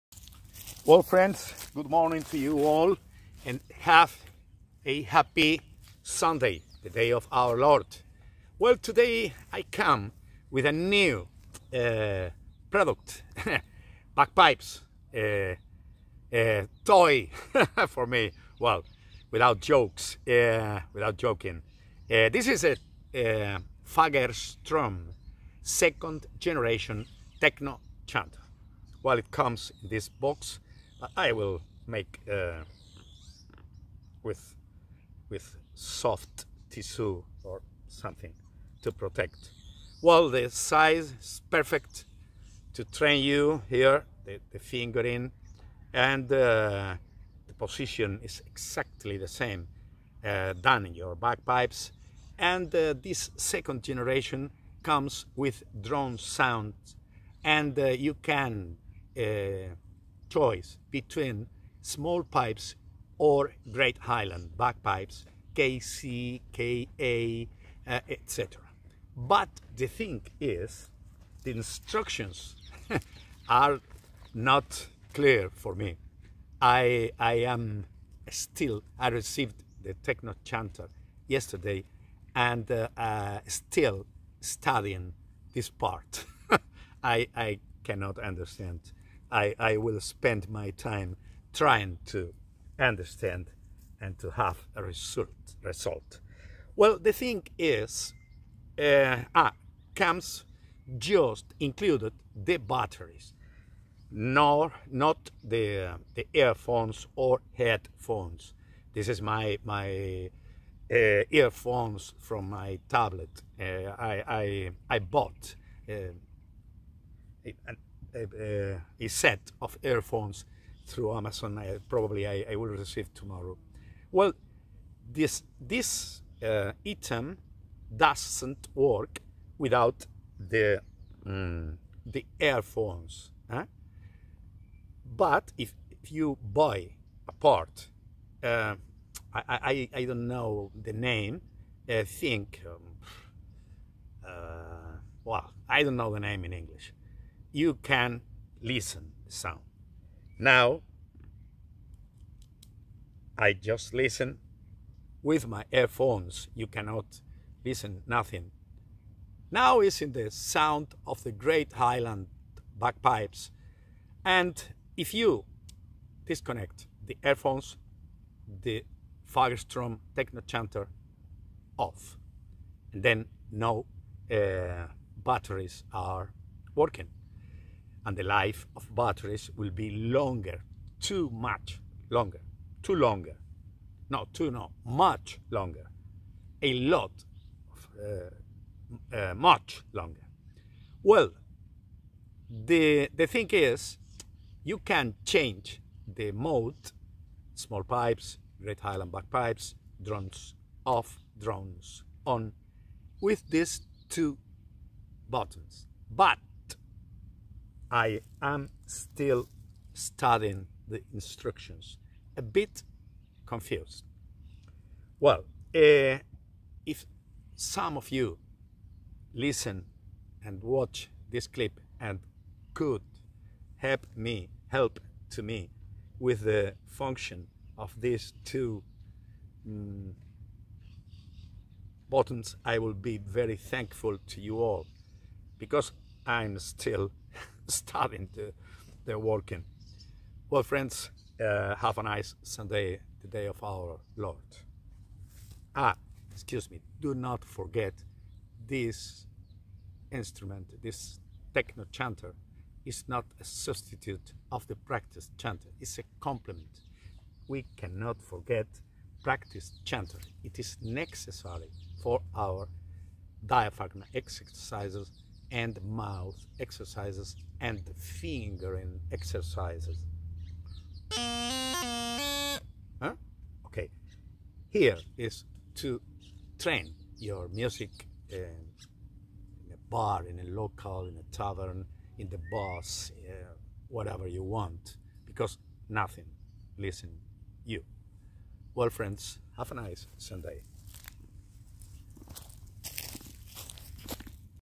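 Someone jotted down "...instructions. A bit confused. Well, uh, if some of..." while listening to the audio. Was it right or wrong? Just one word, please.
right.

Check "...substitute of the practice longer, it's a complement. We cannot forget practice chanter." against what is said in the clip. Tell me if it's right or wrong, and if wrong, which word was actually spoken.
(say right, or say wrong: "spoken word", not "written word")
wrong: "chanter", not "longer".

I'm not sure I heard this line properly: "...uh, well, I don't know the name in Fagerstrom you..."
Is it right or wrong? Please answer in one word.
wrong.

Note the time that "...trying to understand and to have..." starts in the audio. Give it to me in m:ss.
1:31.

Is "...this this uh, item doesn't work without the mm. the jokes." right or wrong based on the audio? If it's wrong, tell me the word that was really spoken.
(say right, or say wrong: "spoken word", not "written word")
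wrong: "earphones", not "jokes".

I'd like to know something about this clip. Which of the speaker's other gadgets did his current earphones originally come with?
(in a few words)
tablet.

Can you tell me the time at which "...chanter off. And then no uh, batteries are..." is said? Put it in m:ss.
2:50.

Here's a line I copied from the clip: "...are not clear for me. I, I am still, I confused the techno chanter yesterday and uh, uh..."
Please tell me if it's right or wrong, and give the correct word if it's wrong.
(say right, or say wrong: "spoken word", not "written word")
wrong: "received", not "confused".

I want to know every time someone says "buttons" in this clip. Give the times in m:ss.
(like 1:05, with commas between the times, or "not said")
3:25, 3:52.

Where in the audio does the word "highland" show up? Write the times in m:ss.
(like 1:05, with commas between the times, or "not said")
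1:03, 2:41, 3:18.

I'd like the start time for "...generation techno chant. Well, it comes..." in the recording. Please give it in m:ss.
0:26.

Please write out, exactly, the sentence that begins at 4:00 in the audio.
Well, friends, uh, have a nice Sunday, the day of our Lord.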